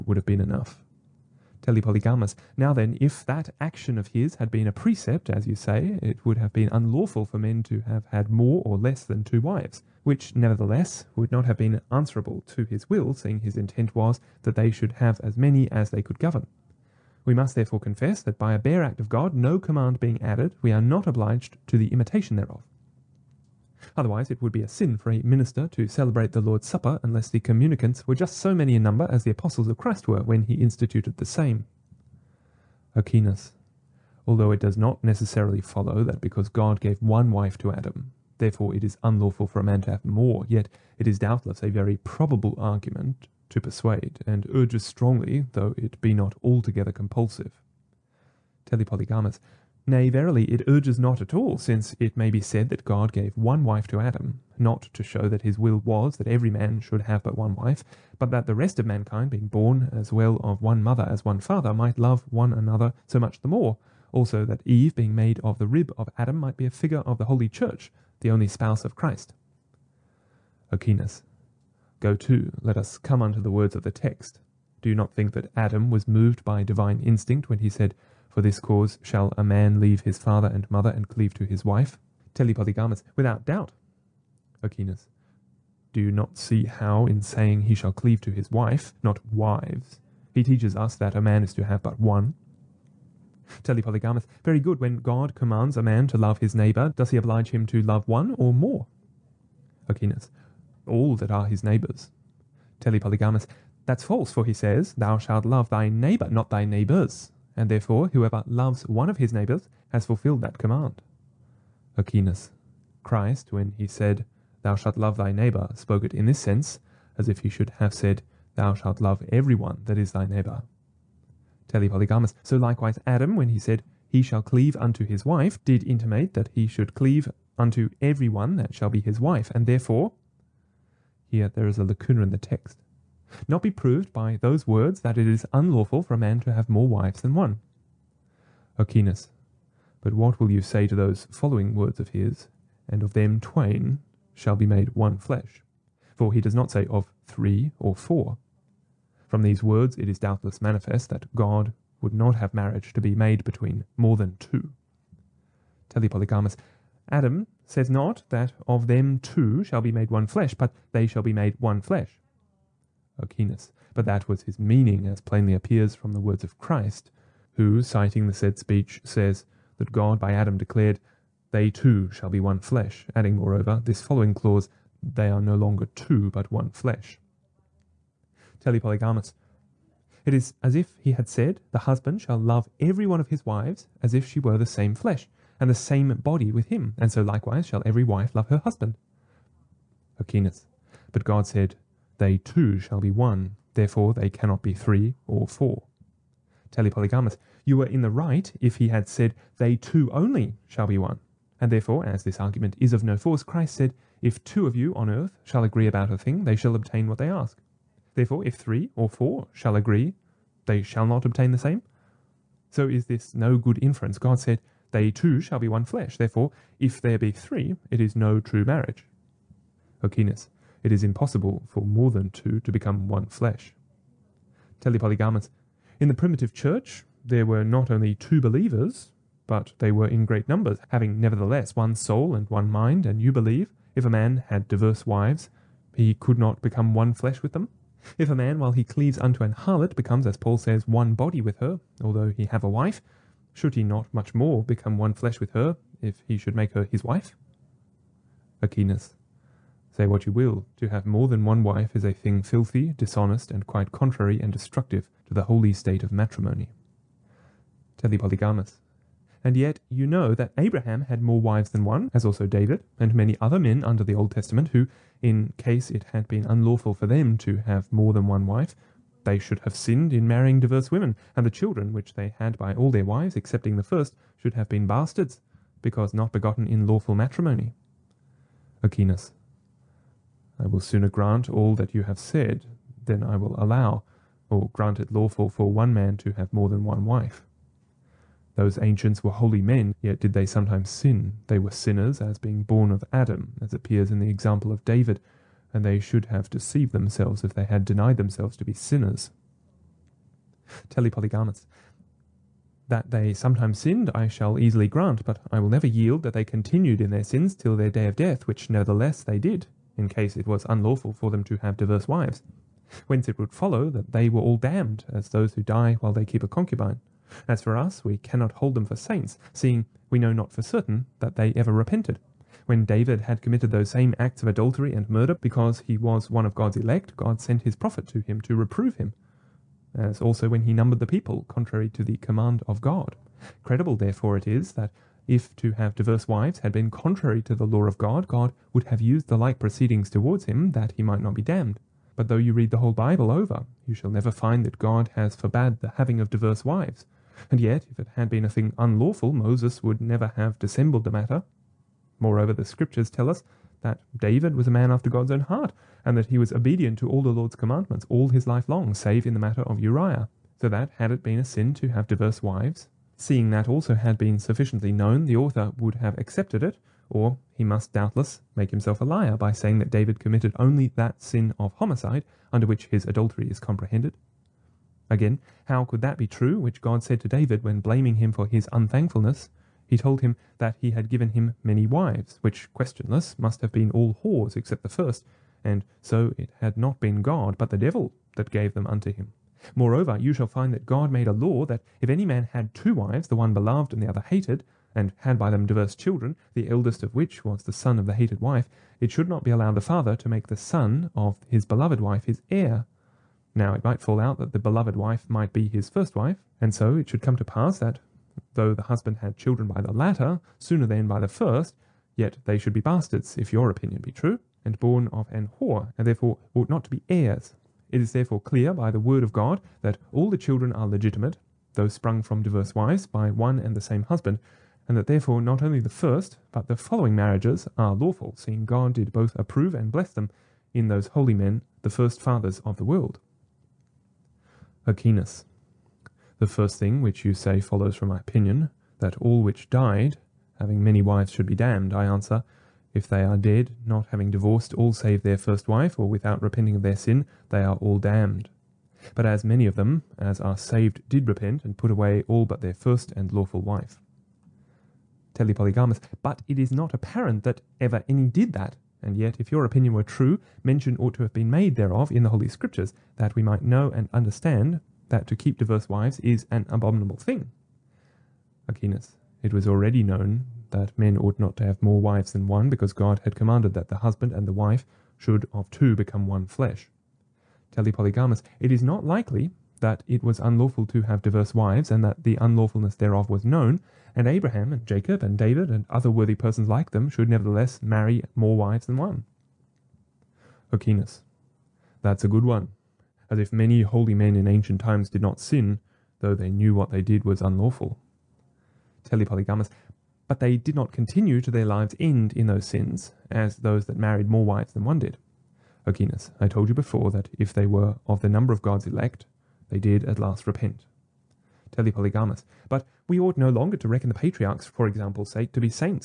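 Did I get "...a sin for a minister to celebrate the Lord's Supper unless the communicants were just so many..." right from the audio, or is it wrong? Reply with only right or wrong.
right.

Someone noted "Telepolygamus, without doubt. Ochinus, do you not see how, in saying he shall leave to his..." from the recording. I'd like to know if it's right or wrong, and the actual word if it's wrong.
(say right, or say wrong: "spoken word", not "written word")
wrong: "cleave", not "leave".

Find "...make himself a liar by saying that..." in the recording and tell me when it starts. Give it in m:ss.
6:08.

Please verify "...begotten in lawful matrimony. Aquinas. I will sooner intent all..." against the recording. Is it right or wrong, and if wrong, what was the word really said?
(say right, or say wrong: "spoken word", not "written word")
wrong: "grant", not "intent".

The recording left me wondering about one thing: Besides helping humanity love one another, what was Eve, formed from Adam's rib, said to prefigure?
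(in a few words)
the Holy Church.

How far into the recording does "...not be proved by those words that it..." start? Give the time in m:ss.
2:13.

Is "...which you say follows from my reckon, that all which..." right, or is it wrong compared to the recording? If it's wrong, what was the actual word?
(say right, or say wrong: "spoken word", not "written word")
wrong: "opinion", not "reckon".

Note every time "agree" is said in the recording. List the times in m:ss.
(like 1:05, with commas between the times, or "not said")
3:25, 3:29.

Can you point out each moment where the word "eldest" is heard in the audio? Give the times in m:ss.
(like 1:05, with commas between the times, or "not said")
6:36.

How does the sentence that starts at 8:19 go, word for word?
Telly but they did not continue to their lives' end in those sins, as those that married more wives than one did.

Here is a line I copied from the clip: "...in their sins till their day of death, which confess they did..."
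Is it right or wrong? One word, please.
wrong.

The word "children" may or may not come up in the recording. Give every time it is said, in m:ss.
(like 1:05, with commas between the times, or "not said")
4:31, 6:35, 6:49, 7:00.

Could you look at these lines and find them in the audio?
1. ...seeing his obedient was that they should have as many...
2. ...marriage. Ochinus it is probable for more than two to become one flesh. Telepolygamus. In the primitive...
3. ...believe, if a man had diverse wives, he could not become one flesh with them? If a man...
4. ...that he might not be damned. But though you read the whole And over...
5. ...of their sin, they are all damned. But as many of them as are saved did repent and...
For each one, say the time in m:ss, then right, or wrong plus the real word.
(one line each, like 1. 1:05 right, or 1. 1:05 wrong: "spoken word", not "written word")
1. 0:13 wrong: "intent", not "obedient"
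2. 3:38 wrong: "impossible", not "probable"
3. 3:53 right
4. 5:40 wrong: "Bible", not "And"
5. 7:26 right.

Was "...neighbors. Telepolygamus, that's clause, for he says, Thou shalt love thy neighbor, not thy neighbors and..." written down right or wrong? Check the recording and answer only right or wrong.
wrong.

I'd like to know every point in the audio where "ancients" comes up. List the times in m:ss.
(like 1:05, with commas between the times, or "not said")
4:48, 8:14.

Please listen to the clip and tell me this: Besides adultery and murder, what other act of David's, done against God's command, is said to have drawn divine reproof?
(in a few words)
numbered the people.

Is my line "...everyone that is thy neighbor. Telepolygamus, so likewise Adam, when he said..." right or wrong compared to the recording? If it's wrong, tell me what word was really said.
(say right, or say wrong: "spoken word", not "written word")
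right.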